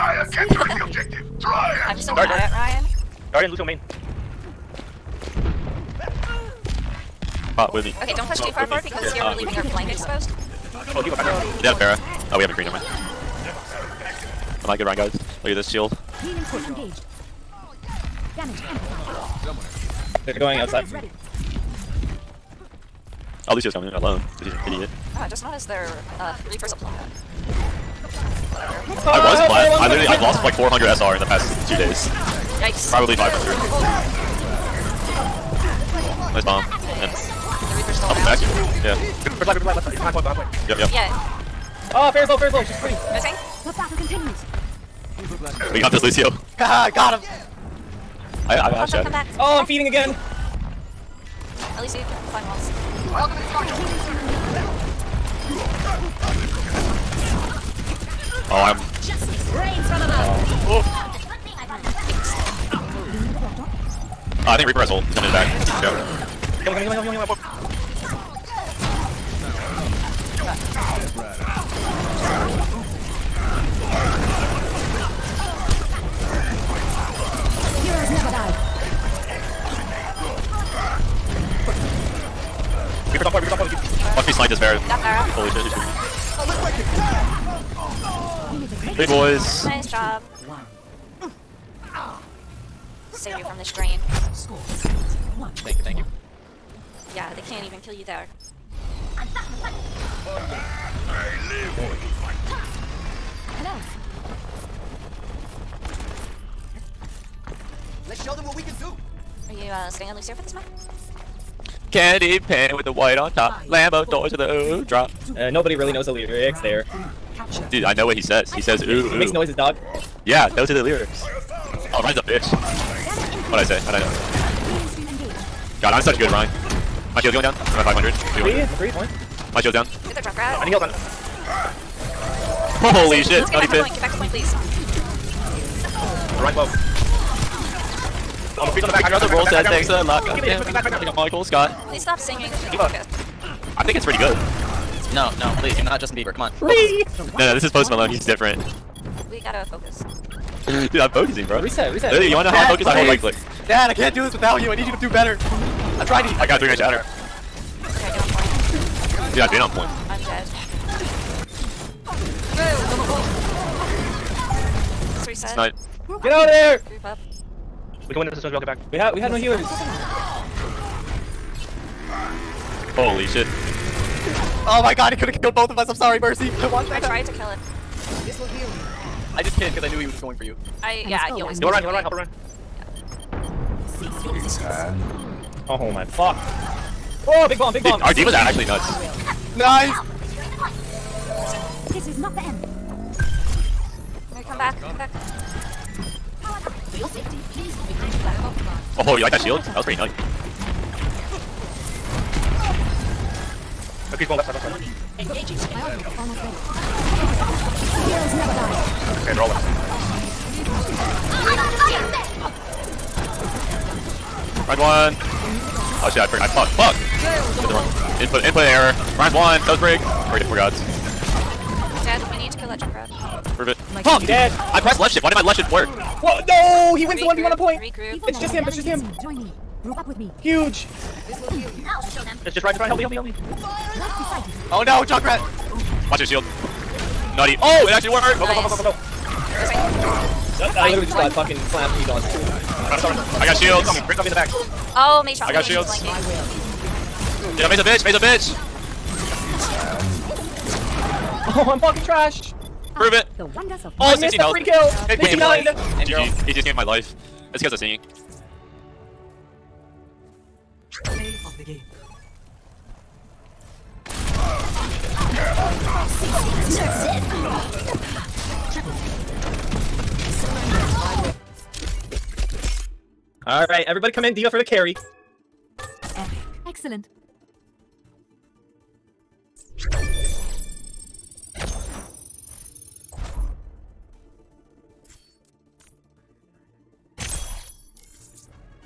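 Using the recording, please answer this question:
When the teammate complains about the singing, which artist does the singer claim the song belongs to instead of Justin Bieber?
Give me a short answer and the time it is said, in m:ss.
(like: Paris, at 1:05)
Post Malone, at 2:27.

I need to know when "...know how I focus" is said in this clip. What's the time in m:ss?
2:32.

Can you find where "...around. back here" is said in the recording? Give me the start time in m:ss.
0:38.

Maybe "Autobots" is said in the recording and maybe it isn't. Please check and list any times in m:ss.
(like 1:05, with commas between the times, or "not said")
not said.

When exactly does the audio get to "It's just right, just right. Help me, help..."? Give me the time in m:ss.
3:52.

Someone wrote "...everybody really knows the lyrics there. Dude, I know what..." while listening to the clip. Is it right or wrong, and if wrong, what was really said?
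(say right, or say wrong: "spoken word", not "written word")
wrong: "nobody", not "everybody".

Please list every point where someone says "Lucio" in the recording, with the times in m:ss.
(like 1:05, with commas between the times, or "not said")
0:03, 0:23, 0:46.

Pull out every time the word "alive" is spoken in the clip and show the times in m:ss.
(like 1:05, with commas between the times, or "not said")
0:39.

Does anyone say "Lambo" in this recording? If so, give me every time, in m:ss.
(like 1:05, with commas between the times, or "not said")
1:53.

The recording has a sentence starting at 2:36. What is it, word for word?
I'm got a three man shatter.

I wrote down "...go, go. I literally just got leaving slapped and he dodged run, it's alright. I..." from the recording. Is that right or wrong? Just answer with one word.
wrong.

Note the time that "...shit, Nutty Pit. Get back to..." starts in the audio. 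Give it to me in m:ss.
2:13.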